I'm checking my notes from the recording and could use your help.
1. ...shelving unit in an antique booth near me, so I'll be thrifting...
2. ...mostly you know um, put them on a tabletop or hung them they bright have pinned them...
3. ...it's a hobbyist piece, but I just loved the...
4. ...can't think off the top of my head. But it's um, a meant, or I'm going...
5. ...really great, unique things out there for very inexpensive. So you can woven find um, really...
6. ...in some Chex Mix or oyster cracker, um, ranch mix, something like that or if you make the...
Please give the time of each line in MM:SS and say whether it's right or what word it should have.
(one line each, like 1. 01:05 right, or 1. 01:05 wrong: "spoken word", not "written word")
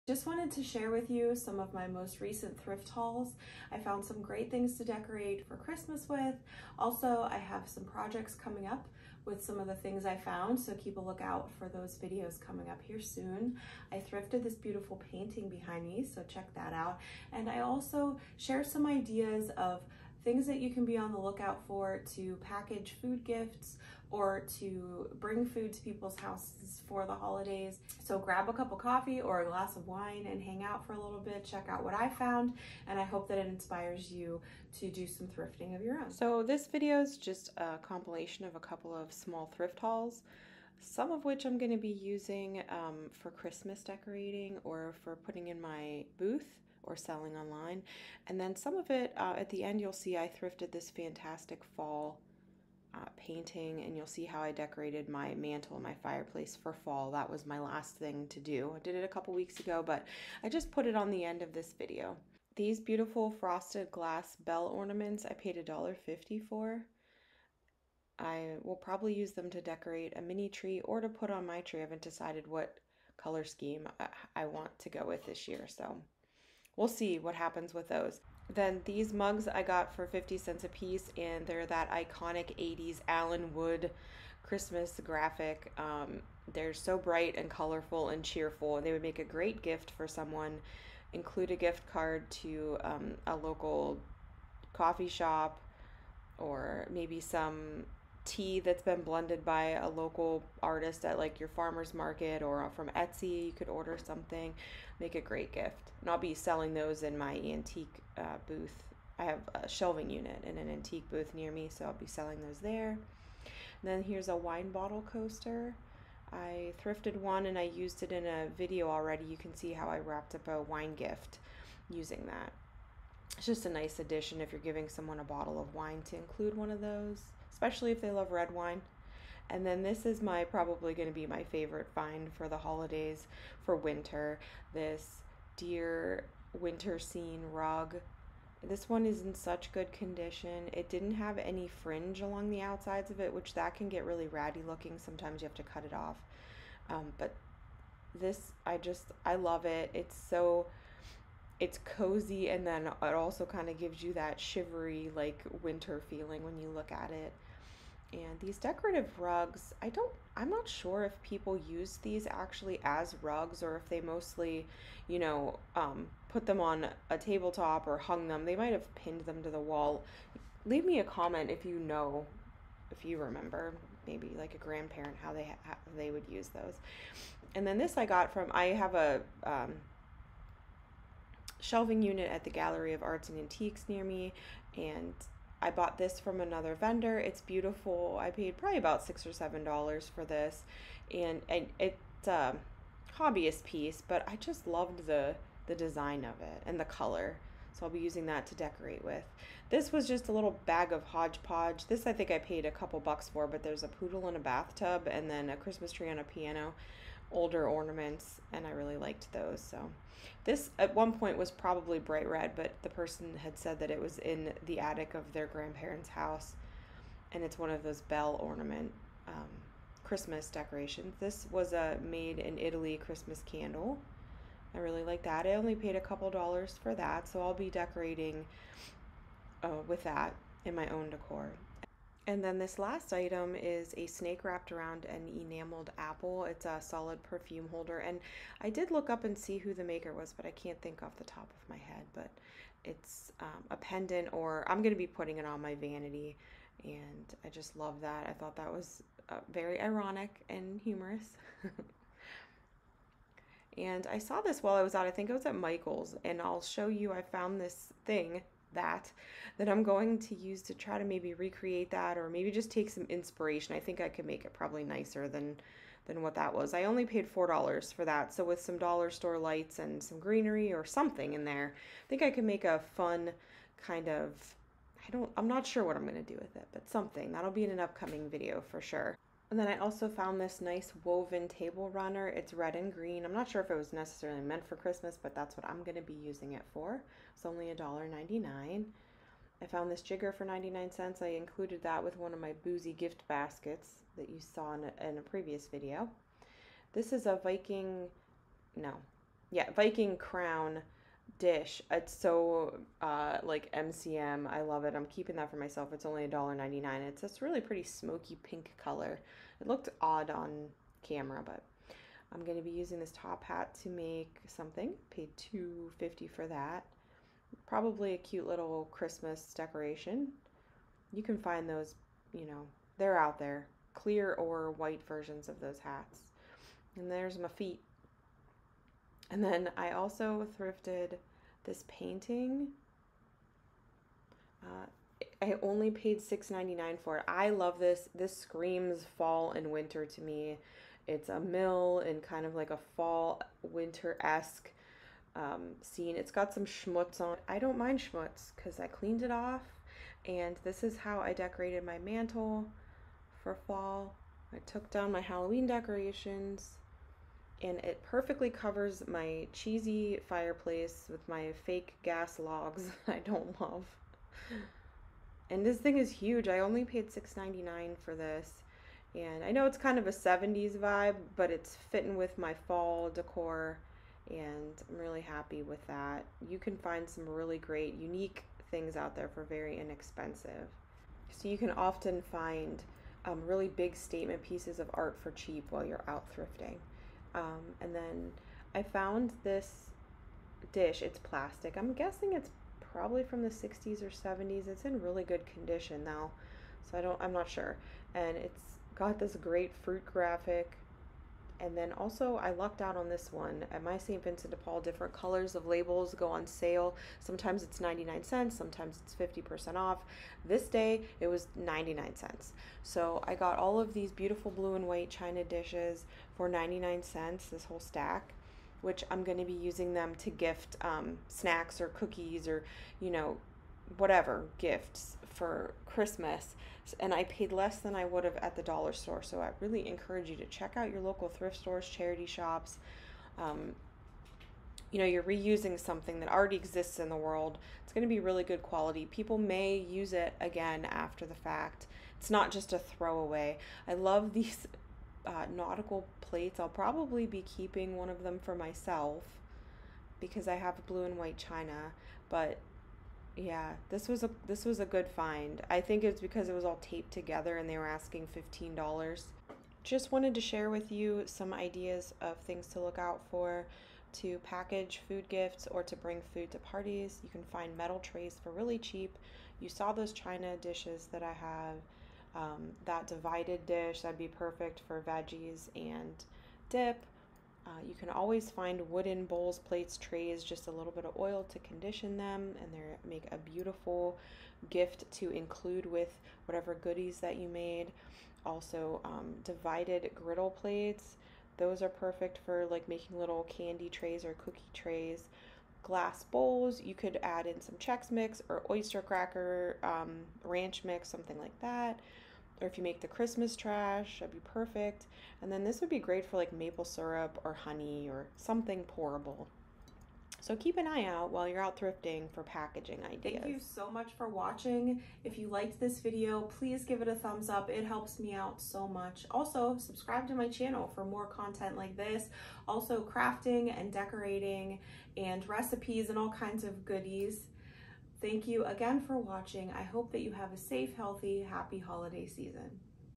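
1. 01:49 wrong: "selling", not "thrifting"
2. 02:44 wrong: "might", not "bright"
3. 03:11 right
4. 04:00 wrong: "pendant", not "meant"
5. 06:17 wrong: "often", not "woven"
6. 08:17 right.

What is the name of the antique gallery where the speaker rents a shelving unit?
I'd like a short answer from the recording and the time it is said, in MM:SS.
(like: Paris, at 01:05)
Gallery of Arts and Antiques, at 03:02.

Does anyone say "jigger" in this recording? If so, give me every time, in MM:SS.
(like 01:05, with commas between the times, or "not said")
04:50.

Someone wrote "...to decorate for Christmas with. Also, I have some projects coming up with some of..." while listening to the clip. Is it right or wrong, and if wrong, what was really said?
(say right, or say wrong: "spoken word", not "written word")
right.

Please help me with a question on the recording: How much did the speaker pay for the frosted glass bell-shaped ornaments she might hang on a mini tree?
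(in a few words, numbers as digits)
$1.50.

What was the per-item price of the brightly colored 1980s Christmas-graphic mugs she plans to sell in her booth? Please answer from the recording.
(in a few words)
50 cents.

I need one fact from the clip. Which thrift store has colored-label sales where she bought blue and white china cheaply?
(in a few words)
St. Vincent de Paul.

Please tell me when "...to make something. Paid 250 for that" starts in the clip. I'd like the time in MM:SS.
05:13.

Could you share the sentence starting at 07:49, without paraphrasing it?
You saw those china dishes that I have.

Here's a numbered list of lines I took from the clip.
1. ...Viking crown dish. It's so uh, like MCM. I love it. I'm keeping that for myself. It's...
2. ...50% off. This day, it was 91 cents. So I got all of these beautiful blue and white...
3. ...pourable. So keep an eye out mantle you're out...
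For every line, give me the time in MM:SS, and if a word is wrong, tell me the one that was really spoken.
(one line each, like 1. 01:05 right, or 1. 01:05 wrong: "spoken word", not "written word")
1. 04:59 right
2. 06:49 wrong: "99", not "91"
3. 08:28 wrong: "while", not "mantle".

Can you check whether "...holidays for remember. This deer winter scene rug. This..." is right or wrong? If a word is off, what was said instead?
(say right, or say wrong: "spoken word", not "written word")
wrong: "winter", not "remember".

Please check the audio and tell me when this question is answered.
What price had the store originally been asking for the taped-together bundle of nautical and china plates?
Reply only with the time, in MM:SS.
07:38.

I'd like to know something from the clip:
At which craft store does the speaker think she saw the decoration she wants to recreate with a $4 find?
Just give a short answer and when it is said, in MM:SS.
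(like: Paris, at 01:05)
Michael's, at 04:15.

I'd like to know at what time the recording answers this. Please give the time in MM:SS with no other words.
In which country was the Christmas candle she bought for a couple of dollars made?
03:42.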